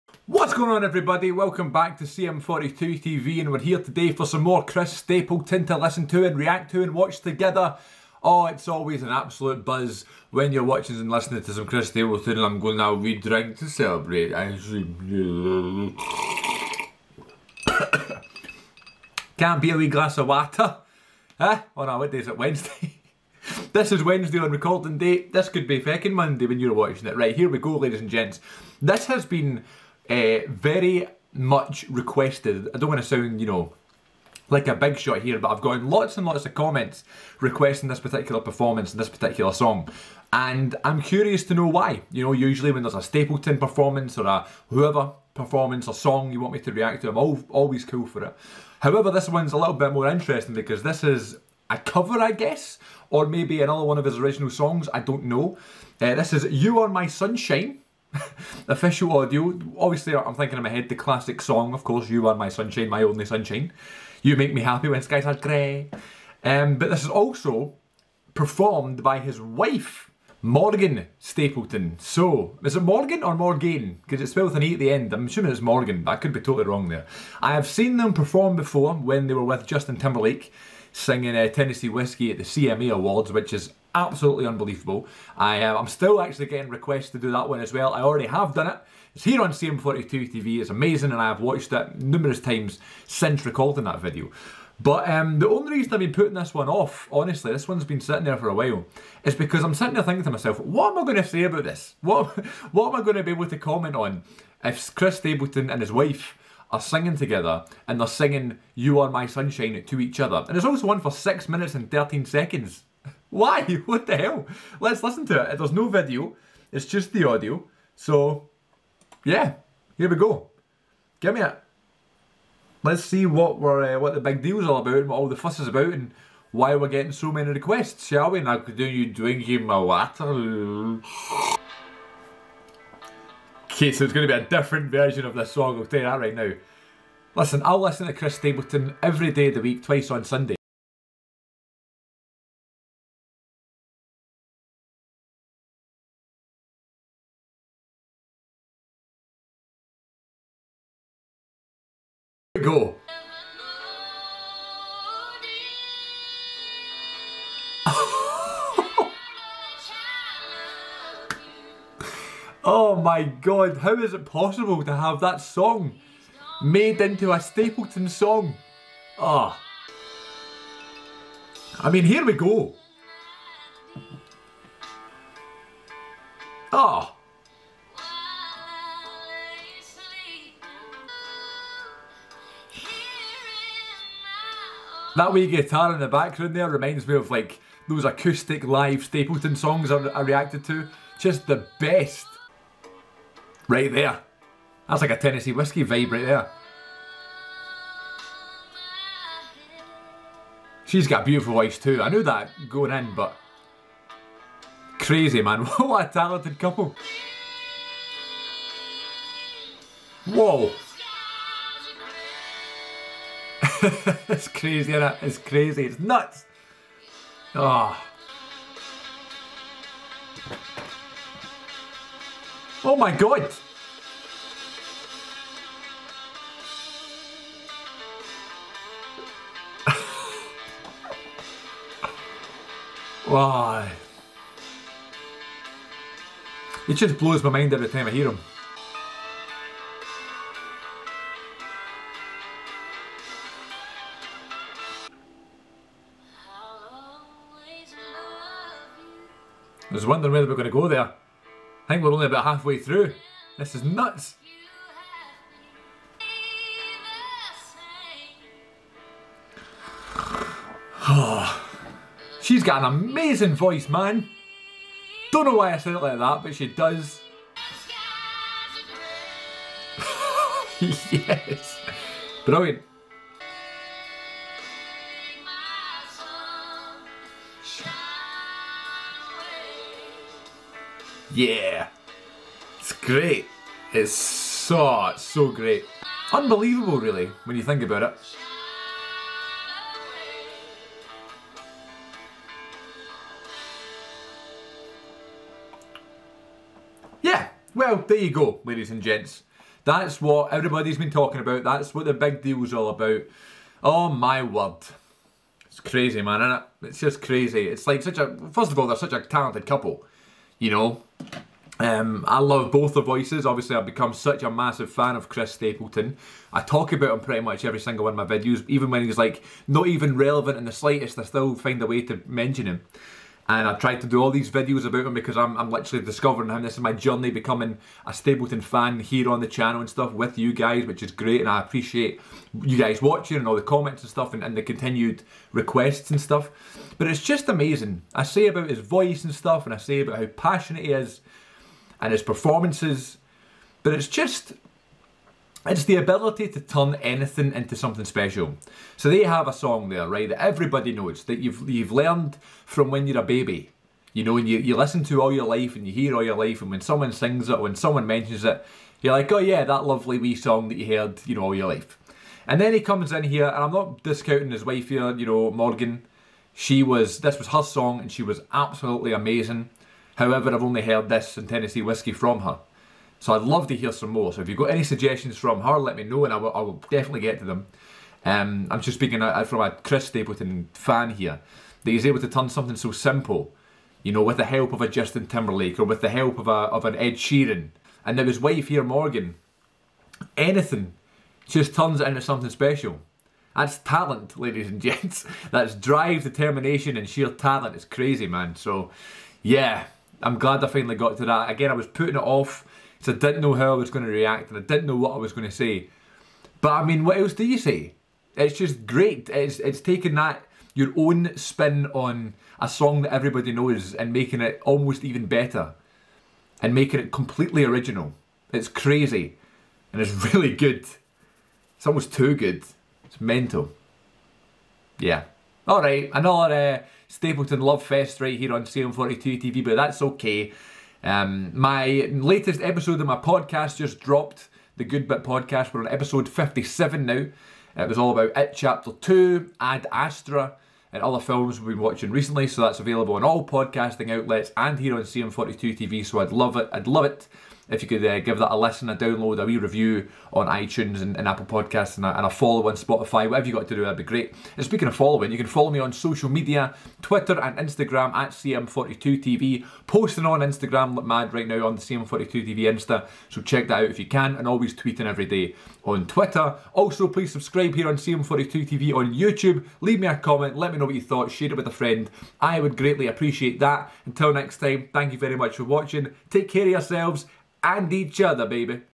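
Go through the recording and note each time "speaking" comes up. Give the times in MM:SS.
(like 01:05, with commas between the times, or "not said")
06:18, 07:34.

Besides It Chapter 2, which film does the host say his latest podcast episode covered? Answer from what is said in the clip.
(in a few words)
Ad Astra.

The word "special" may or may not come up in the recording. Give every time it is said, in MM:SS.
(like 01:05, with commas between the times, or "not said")
05:48, 06:32.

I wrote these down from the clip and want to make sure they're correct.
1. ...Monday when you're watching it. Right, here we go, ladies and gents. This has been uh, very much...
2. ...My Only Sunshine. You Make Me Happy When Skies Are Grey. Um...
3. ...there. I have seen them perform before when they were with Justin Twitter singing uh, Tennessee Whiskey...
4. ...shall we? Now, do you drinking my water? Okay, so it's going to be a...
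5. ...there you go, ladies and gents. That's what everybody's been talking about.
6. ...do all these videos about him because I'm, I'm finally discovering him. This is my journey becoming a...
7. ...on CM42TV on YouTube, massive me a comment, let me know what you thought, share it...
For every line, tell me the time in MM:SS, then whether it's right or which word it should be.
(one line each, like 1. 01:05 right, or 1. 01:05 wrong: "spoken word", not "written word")
1. 00:26 right
2. 01:02 right
3. 01:16 wrong: "Timberlake", not "Twitter"
4. 02:08 right
5. 04:58 right
6. 05:24 wrong: "literally", not "finally"
7. 07:47 wrong: "leave", not "massive".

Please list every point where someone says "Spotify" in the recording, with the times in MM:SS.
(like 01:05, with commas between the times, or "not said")
07:32.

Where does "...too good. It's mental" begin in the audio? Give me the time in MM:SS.
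07:02.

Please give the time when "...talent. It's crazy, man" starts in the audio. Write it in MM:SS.
06:37.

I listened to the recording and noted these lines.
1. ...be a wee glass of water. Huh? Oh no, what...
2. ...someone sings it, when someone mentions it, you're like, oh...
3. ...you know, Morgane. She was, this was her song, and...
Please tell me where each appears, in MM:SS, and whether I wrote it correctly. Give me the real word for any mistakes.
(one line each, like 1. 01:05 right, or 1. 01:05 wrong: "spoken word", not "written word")
1. 00:19 right
2. 05:56 right
3. 06:05 right.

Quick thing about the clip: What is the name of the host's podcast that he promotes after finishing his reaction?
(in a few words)
The Good Bit Podcast.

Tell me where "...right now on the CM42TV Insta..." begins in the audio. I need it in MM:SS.
07:41.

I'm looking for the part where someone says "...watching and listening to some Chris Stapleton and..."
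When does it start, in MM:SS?
00:10.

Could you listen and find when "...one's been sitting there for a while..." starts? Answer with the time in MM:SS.
01:37.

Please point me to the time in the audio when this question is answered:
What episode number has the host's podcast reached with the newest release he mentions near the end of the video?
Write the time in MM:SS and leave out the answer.
07:16.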